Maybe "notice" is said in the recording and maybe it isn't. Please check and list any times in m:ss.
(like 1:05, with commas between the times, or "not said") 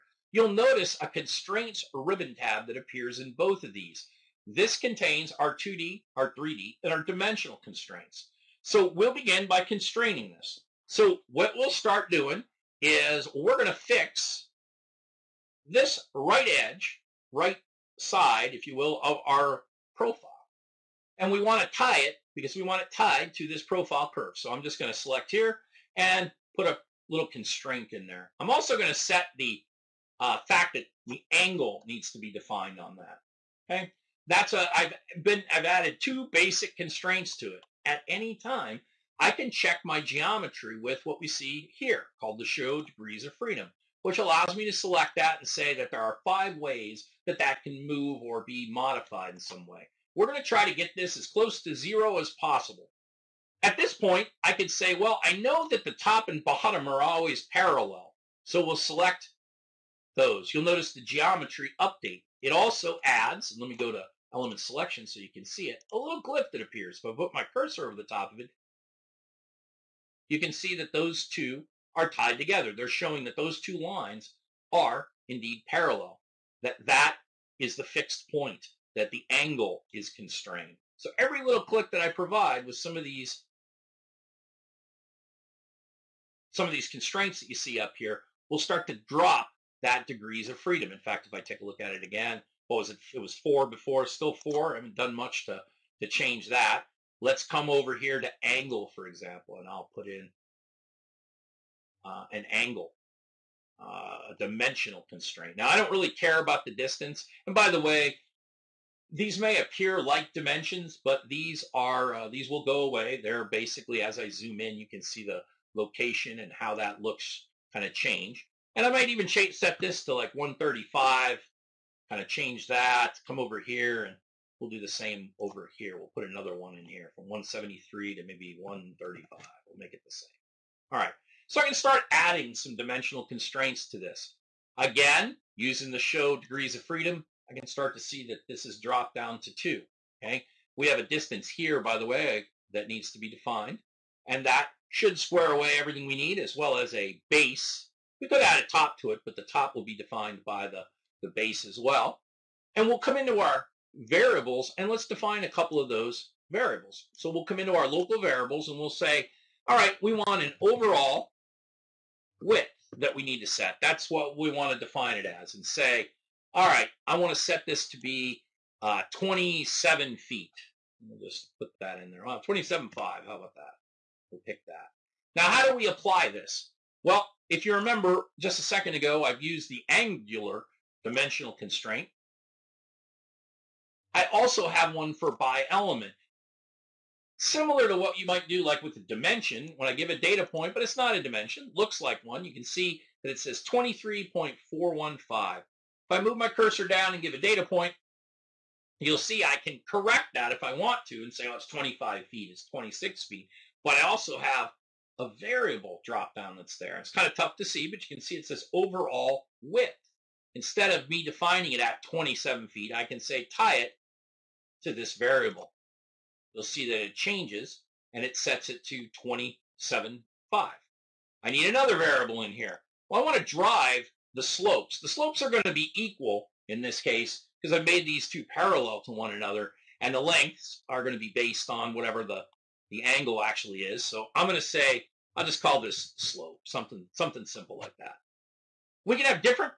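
0:00, 1:00.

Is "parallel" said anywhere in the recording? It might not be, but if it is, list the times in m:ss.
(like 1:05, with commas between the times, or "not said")
0:57, 1:15, 3:48.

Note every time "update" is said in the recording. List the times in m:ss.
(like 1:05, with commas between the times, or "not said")
1:01.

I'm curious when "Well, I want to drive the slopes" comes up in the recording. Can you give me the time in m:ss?
3:43.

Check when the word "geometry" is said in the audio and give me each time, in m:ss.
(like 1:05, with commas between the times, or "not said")
0:40, 1:01.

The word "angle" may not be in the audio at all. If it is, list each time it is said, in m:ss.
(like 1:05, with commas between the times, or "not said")
0:31, 1:19, 1:38, 1:42, 3:53.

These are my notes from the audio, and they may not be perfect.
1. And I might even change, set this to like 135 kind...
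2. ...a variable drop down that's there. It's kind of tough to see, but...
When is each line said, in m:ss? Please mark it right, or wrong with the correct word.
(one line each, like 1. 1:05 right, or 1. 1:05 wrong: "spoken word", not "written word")
1. 1:58 right
2. 3:25 right.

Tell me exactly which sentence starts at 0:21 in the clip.
And we want to tie it because we want it tied to this profile curve.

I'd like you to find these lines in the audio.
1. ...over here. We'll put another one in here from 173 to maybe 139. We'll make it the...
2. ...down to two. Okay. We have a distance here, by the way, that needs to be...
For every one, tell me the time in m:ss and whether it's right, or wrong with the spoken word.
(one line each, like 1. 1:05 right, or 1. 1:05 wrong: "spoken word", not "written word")
1. 2:05 wrong: "135", not "139"
2. 2:19 right.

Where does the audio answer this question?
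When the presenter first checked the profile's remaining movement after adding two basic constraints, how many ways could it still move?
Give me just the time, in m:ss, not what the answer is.
0:46.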